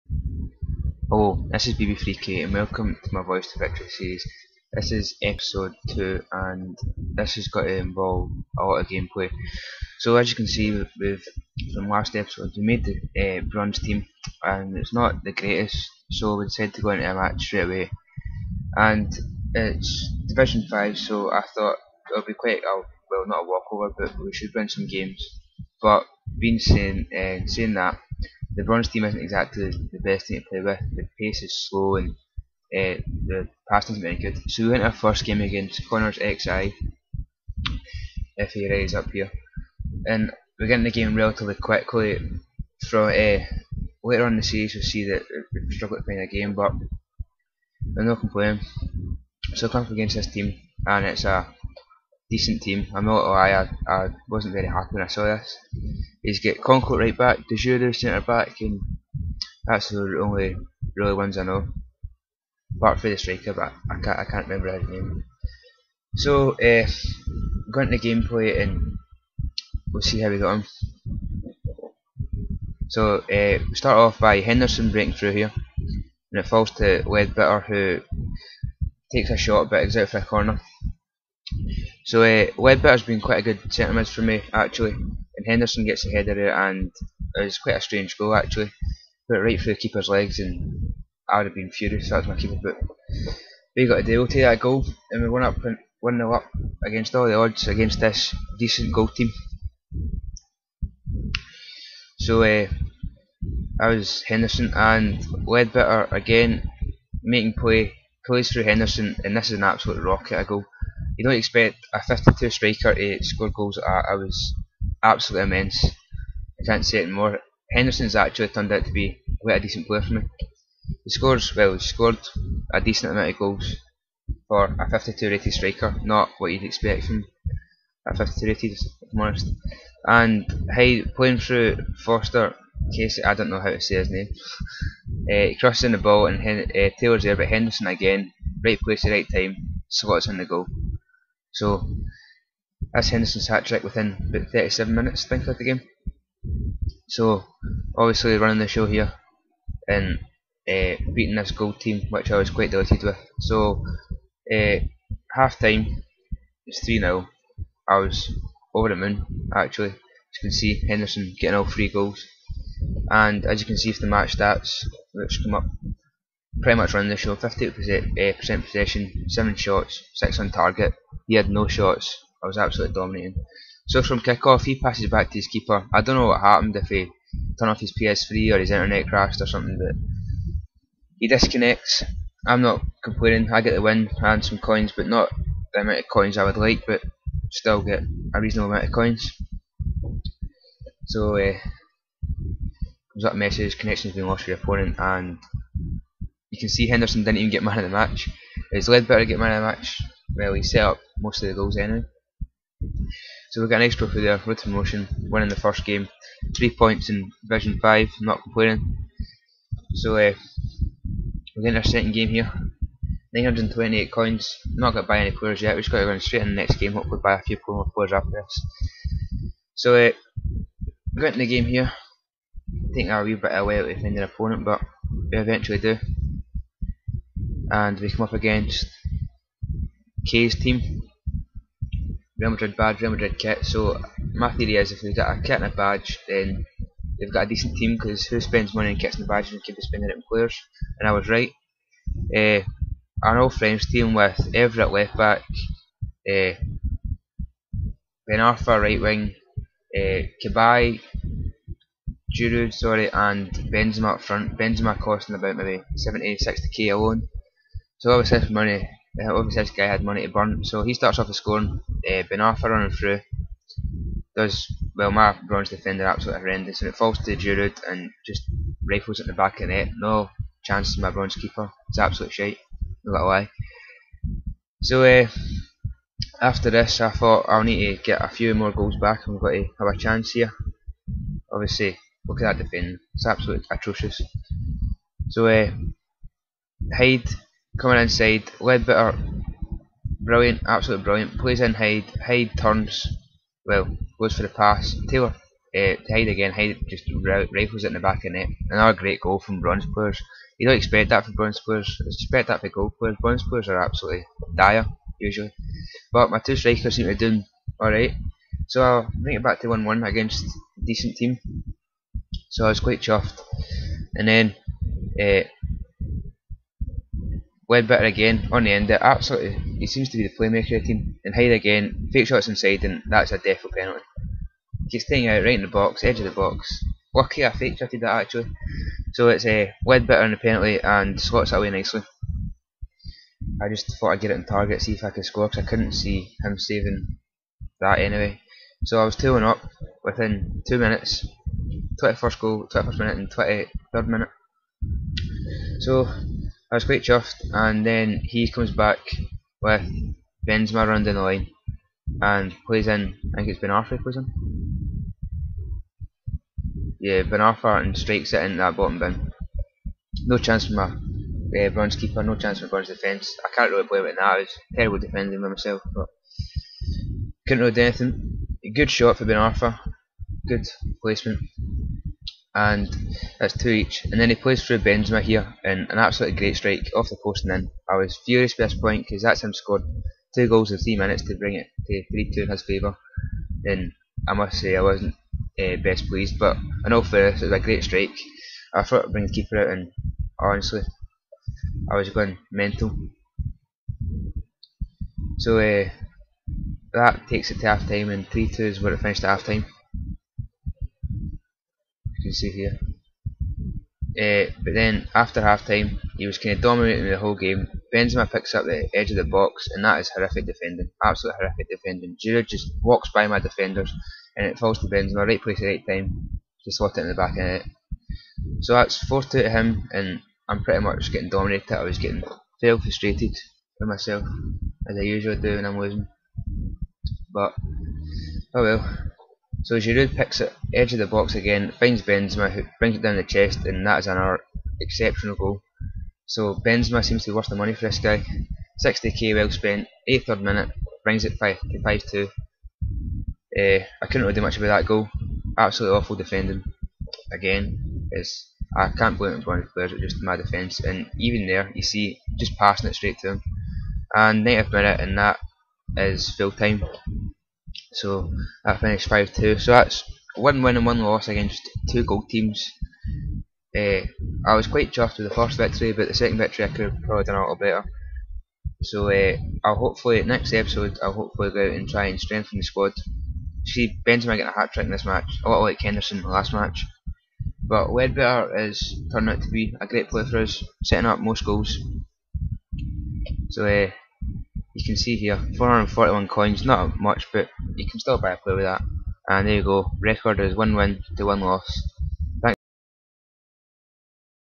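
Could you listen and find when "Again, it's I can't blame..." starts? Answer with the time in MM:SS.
07:27.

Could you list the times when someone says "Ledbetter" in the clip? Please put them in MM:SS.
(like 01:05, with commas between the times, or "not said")
01:17, 01:22, 01:45, 03:18, 04:48, 05:17, 05:29, 07:57.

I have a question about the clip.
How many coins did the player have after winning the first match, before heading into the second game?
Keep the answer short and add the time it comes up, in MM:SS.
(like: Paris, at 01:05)
928, at 03:33.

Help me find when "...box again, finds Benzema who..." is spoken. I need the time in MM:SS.
07:11.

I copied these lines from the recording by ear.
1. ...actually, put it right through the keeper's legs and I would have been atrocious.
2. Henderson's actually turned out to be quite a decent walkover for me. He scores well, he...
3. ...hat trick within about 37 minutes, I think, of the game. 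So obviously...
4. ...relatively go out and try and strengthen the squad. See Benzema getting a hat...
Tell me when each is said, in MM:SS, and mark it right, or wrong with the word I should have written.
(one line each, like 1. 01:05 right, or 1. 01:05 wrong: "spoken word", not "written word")
1. 01:28 wrong: "furious", not "atrocious"
2. 01:57 wrong: "player", not "walkover"
3. 02:23 right
4. 07:51 wrong: "hopefully", not "relatively".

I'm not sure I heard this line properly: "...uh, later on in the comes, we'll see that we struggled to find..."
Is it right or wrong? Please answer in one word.
wrong.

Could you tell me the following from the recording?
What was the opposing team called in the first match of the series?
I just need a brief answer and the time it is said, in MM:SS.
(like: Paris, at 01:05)
Connors XI, at 00:35.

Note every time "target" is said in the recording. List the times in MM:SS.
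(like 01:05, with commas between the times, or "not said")
02:50, 05:34.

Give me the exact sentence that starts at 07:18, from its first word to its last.
60k well spent, 83rd minute, brings it 5 to 5 2.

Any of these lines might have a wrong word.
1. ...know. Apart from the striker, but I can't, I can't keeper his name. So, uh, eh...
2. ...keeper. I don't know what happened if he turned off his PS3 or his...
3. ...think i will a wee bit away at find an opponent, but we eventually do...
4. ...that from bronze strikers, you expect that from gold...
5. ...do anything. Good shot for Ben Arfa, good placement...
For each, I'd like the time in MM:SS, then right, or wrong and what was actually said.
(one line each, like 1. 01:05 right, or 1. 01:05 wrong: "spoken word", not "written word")
1. 01:01 wrong: "remember", not "keeper"
2. 02:55 right
3. 03:42 right
4. 05:01 wrong: "players", not "strikers"
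5. 06:07 right.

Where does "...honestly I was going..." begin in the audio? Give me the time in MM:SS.
06:30.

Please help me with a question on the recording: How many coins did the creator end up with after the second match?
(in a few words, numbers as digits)
441.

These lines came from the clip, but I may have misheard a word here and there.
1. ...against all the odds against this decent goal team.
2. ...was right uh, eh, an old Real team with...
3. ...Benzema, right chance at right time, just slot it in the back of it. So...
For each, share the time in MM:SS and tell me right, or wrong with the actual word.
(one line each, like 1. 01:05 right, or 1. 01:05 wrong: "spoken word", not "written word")
1. 01:36 right
2. 04:01 wrong: "French", not "Real"
3. 06:54 wrong: "place", not "chance".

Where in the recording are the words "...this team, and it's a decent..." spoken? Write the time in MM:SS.
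00:50.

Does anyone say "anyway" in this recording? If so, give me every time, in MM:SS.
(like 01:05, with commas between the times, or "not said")
03:21, 05:37.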